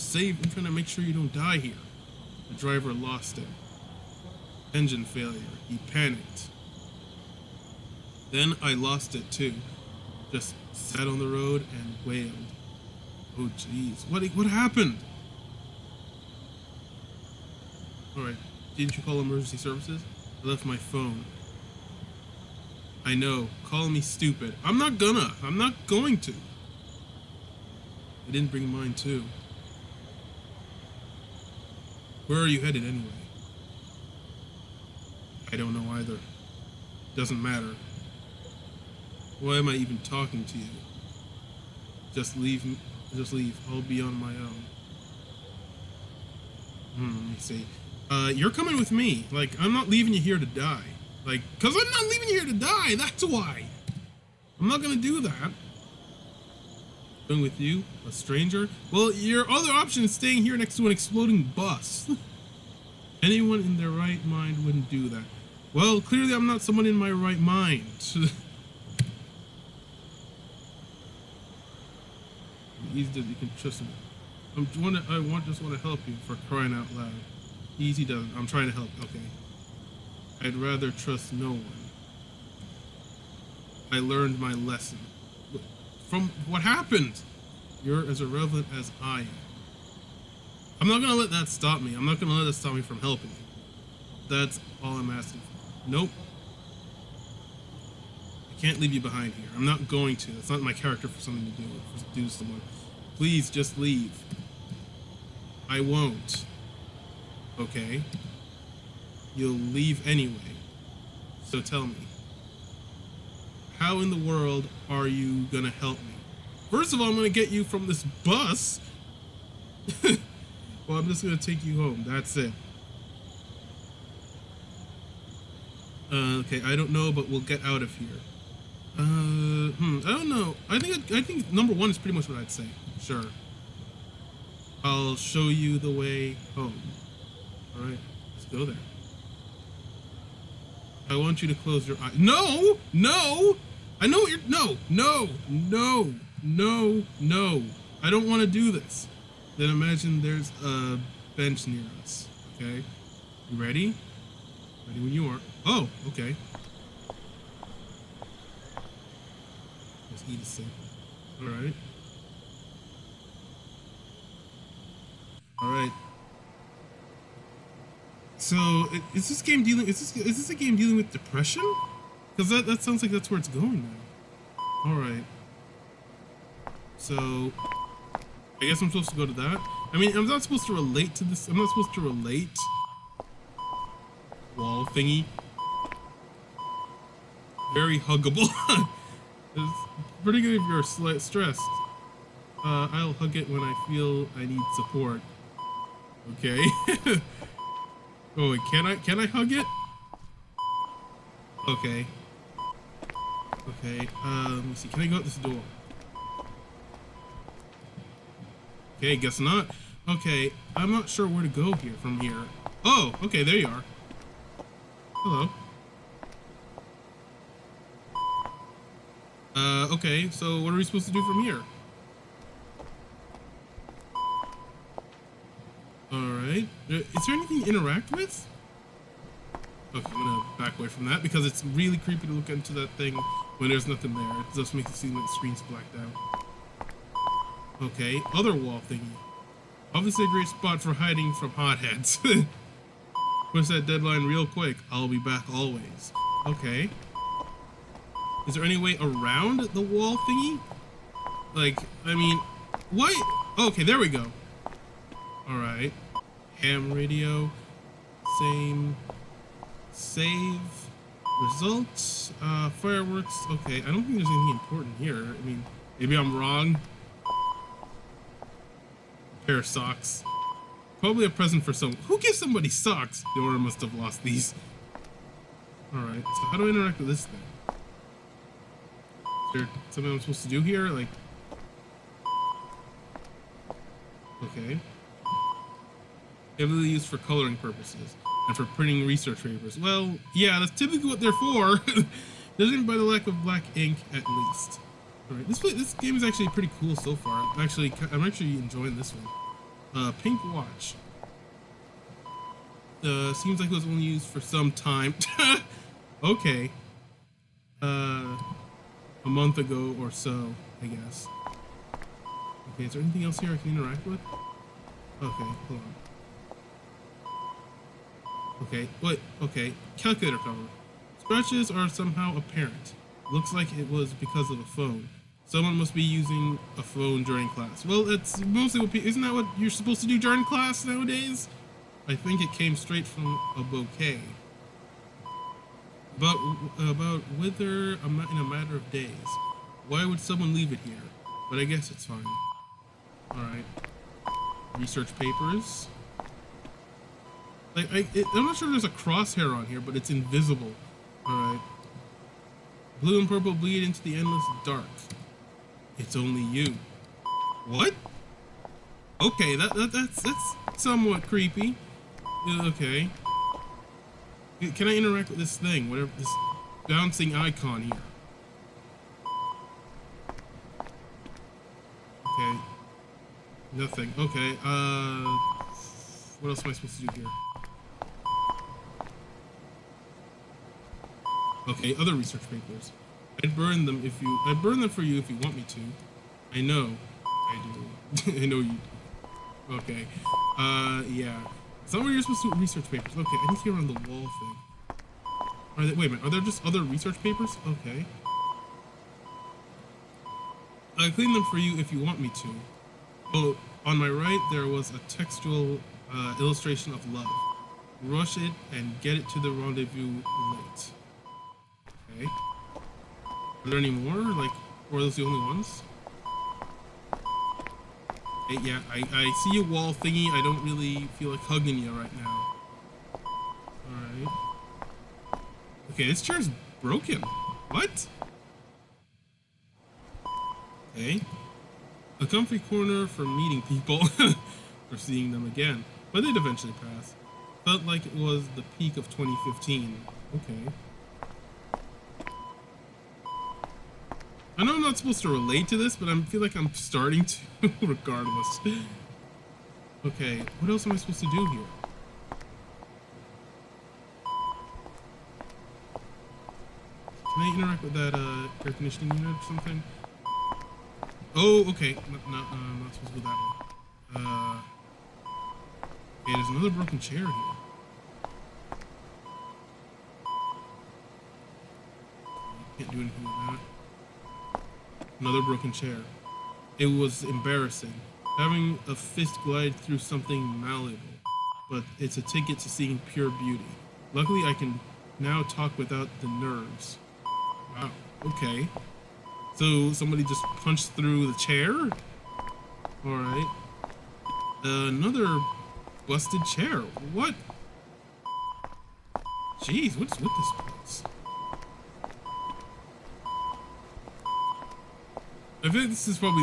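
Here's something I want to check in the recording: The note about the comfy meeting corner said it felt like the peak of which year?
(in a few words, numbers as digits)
2015.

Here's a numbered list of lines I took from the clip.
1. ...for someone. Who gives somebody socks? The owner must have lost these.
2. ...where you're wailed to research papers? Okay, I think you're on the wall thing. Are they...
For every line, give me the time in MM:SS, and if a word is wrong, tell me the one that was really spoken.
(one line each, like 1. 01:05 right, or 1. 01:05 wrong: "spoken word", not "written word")
1. 04:31 right
2. 06:32 wrong: "supposed", not "wailed".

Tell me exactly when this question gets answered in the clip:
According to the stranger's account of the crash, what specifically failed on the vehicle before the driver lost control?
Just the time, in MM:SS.
00:04.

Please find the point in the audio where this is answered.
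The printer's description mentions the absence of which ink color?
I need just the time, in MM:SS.
04:53.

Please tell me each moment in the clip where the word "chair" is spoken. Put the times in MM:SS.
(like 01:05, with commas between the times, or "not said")
07:06, 07:46, 07:55, 08:11, 08:16.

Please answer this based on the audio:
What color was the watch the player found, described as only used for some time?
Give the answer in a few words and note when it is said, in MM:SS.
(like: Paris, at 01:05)
Pink, at 05:00.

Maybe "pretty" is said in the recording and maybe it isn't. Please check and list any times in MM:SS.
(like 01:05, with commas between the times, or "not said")
02:11, 03:10, 04:56.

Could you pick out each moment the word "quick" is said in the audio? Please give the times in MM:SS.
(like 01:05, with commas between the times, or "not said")
04:04.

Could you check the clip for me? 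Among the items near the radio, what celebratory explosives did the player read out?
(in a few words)
Fireworks.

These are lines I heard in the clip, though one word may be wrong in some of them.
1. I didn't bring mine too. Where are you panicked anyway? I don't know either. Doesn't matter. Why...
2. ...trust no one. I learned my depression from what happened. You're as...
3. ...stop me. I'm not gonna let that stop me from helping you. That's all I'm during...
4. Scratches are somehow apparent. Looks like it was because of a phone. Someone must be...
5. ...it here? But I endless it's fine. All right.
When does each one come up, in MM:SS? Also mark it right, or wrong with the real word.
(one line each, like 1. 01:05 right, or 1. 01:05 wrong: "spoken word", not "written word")
1. 00:28 wrong: "headed", not "panicked"
2. 01:20 wrong: "lesson", not "depression"
3. 01:31 wrong: "asking", not "during"
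4. 05:21 right
5. 05:40 wrong: "guess", not "endless".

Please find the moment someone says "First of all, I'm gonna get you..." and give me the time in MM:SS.
01:56.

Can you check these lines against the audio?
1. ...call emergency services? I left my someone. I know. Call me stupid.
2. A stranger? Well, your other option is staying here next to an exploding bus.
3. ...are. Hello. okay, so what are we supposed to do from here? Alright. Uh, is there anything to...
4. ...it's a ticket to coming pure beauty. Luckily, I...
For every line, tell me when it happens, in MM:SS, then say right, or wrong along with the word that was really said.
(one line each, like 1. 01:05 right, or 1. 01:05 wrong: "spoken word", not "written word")
1. 00:19 wrong: "phone", not "someone"
2. 00:58 right
3. 03:33 right
4. 08:01 wrong: "seeing", not "coming".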